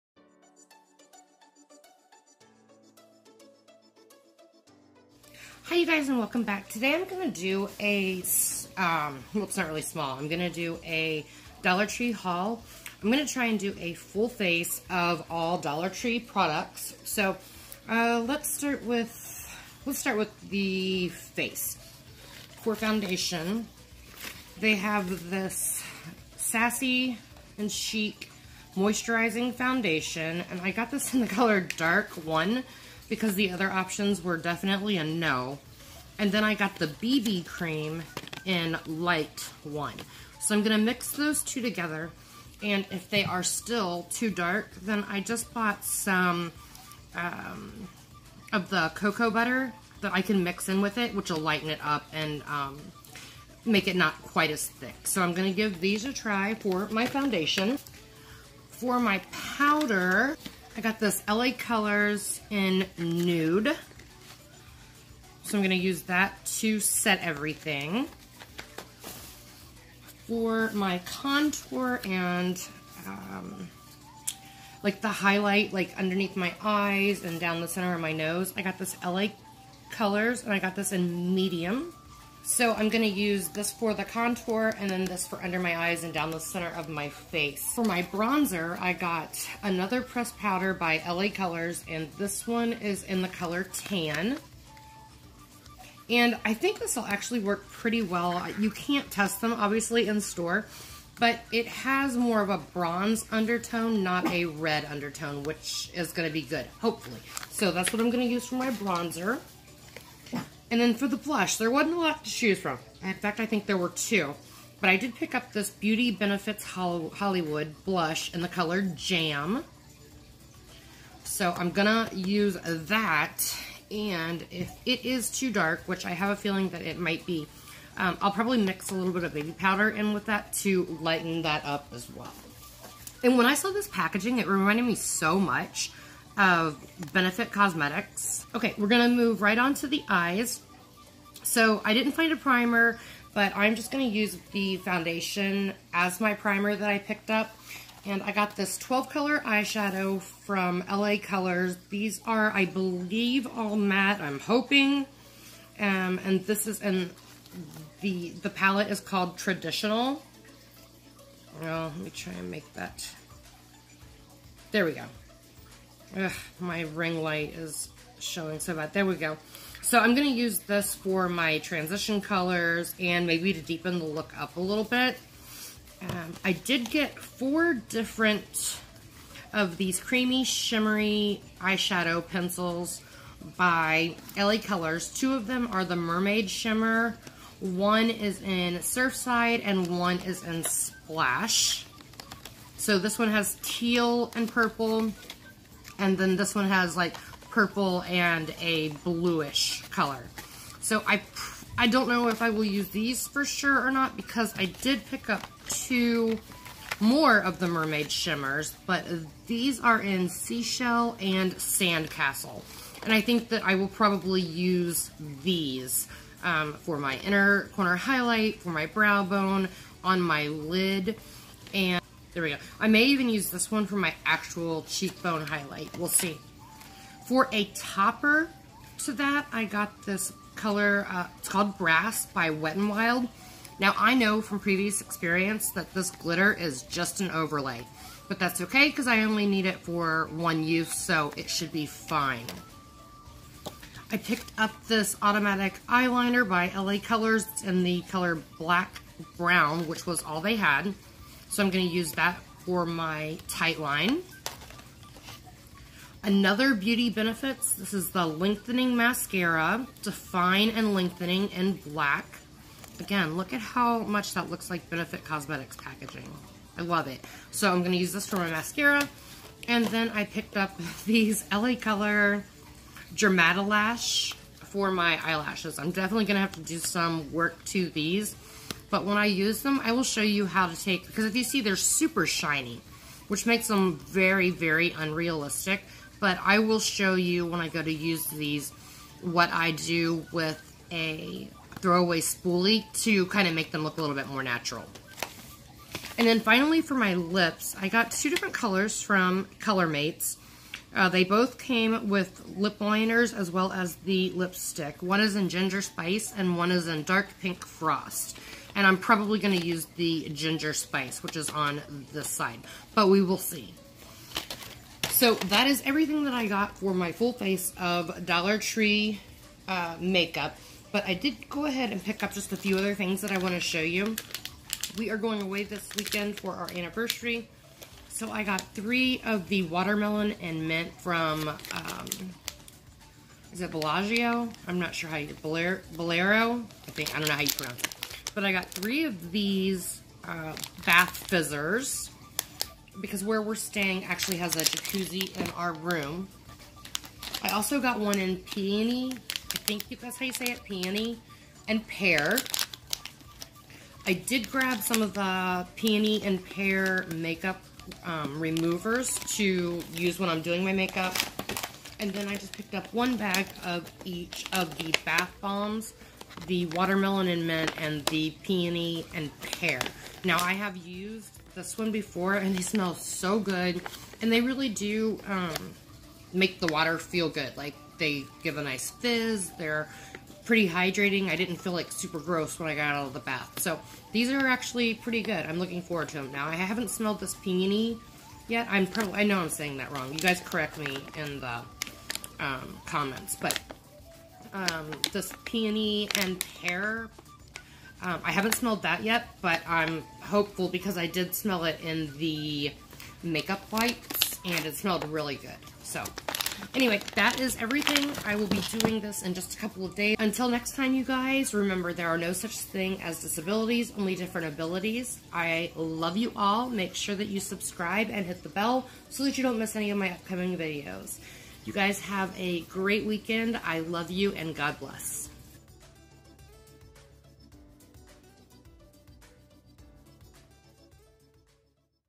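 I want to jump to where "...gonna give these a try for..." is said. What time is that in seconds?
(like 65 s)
55 s.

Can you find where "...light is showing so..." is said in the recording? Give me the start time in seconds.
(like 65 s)
167 s.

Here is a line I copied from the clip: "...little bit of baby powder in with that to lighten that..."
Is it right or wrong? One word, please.
right.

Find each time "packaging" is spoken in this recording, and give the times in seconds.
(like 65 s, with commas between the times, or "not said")
133 s, 265 s.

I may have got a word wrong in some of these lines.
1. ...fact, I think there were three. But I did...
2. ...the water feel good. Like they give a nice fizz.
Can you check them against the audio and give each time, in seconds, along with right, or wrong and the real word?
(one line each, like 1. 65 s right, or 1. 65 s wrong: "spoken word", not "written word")
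1. 113 s wrong: "two", not "three"
2. 376 s right.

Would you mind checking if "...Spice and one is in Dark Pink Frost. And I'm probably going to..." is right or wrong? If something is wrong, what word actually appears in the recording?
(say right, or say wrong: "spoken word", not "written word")
right.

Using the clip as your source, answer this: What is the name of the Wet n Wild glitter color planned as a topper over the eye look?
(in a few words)
Brass.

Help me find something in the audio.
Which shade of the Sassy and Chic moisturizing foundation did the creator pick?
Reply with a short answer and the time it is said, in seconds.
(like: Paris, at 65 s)
Dark 1, at 31 s.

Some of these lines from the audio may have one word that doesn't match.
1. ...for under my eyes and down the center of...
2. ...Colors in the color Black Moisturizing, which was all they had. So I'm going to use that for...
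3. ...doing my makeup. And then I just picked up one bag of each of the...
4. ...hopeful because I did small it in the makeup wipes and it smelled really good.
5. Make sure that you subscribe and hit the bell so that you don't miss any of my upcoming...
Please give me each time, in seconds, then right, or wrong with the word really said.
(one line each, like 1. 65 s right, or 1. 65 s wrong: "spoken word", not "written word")
1. 85 s right
2. 246 s wrong: "Brown", not "Moisturizing"
3. 360 s right
4. 400 s wrong: "smell", not "small"
5. 416 s right.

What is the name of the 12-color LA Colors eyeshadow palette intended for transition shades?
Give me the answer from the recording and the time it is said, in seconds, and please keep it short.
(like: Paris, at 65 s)
Traditional, at 159 s.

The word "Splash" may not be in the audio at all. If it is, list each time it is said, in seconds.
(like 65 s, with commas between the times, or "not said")
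190 s.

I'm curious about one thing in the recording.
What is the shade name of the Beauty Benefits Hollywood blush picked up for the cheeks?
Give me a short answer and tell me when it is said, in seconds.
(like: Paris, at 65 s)
Jam, at 118 s.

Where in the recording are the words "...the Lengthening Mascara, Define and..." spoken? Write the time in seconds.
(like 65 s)
258 s.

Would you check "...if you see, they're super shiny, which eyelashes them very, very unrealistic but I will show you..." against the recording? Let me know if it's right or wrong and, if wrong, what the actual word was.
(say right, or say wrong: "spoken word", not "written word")
wrong: "makes", not "eyelashes".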